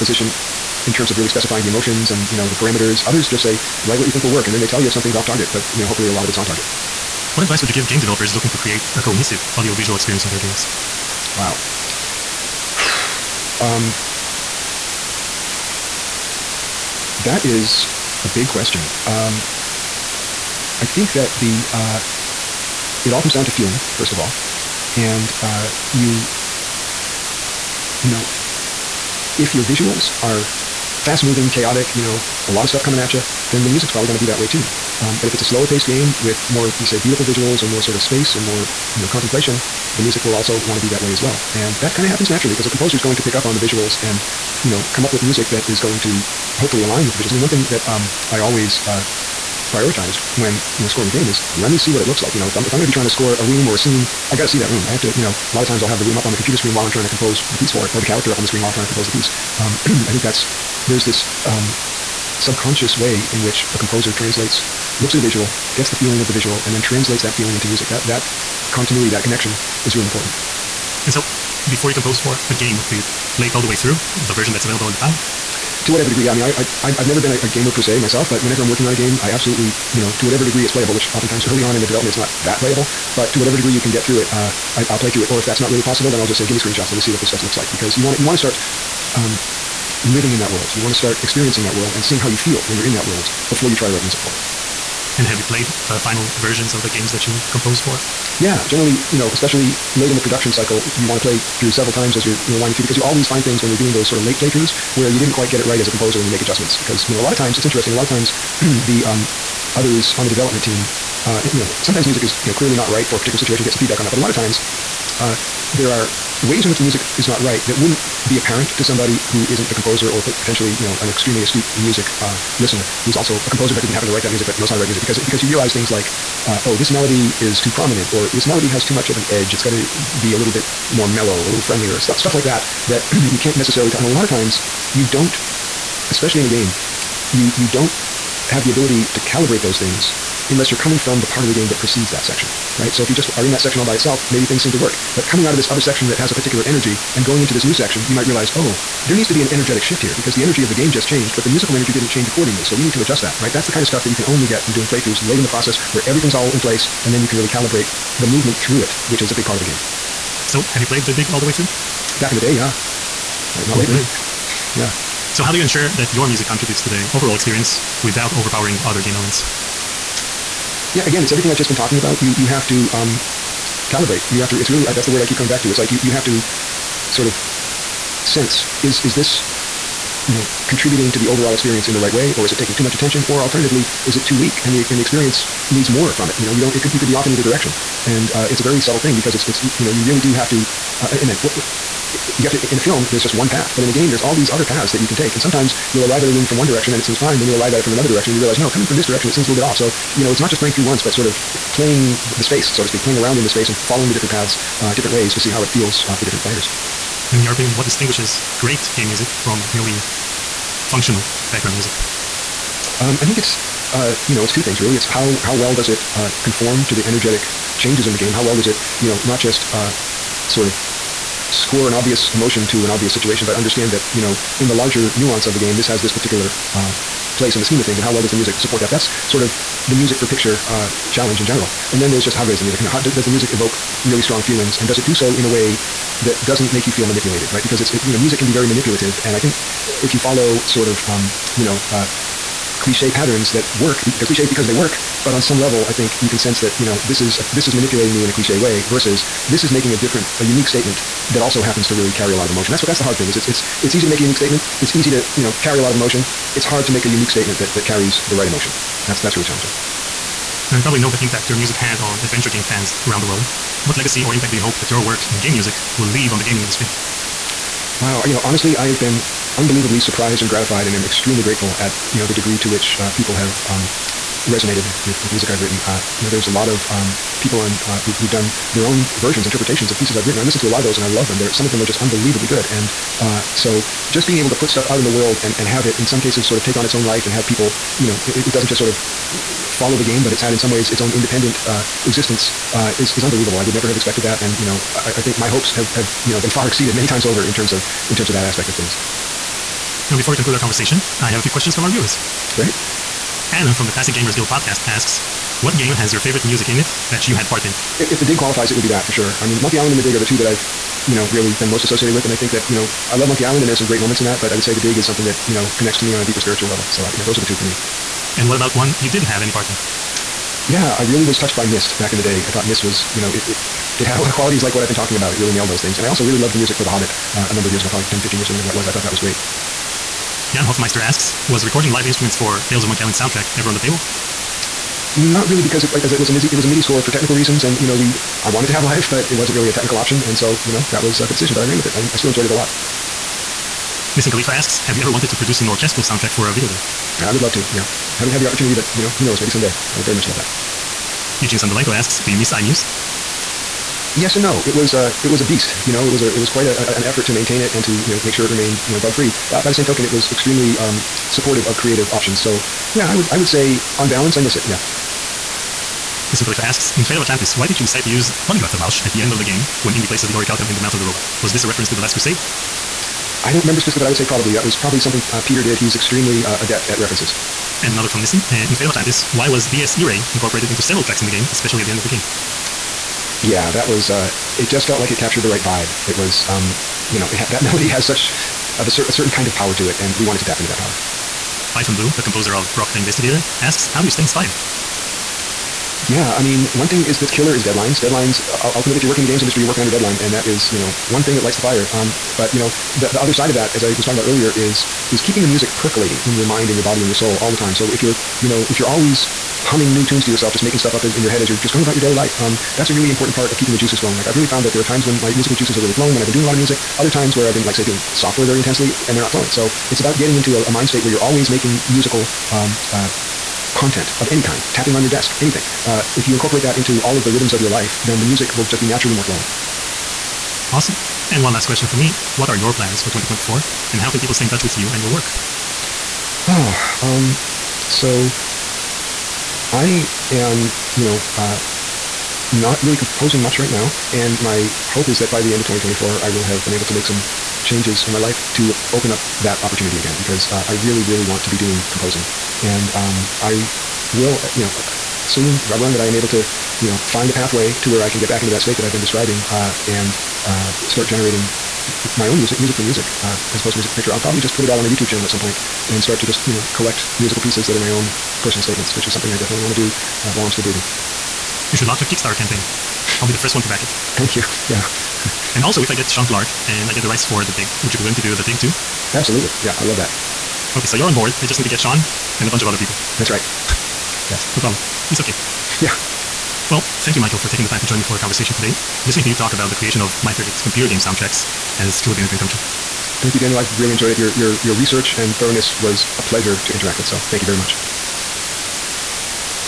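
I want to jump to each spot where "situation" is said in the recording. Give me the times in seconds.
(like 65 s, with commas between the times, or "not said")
113 s, 223 s.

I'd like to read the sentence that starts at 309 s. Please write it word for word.
I mean, Monkey Island and the dig are the two that I've, you know, really been most associated with.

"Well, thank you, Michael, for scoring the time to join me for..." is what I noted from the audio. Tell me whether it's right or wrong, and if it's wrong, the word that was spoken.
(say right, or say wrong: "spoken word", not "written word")
wrong: "taking", not "scoring".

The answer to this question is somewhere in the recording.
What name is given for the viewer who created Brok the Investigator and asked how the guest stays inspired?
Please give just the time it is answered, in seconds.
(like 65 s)
391 s.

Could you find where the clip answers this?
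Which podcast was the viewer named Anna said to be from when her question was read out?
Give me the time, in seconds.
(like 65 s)
303 s.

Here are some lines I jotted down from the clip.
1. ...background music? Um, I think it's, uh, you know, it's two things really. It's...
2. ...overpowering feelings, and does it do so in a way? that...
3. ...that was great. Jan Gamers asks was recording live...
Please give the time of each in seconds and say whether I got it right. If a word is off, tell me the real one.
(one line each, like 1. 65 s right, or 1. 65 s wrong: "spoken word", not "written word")
1. 211 s right
2. 234 s wrong: "strong", not "overpowering"
3. 329 s wrong: "Hofmeister", not "Gamers".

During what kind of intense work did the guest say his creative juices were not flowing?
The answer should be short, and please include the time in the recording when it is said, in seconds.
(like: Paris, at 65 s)
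Software, at 418 s.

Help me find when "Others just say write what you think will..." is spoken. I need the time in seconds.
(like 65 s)
3 s.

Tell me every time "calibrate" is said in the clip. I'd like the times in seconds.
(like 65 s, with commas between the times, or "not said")
139 s, 157 s, 173 s.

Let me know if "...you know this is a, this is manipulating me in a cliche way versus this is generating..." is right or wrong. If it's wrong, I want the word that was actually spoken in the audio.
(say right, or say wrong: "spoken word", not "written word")
wrong: "making", not "generating".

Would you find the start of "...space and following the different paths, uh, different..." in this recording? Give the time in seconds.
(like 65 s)
203 s.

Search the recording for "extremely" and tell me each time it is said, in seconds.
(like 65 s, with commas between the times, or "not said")
121 s, 271 s, 360 s, 375 s.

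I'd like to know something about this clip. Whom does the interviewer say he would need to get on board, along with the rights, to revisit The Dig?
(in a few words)
Sean Clark.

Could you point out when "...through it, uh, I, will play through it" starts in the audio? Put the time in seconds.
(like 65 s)
84 s.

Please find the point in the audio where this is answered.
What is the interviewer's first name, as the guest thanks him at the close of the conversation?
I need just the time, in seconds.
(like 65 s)
493 s.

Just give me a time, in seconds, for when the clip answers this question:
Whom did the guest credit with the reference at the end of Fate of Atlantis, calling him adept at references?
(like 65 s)
375 s.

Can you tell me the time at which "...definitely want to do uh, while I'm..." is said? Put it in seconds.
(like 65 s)
469 s.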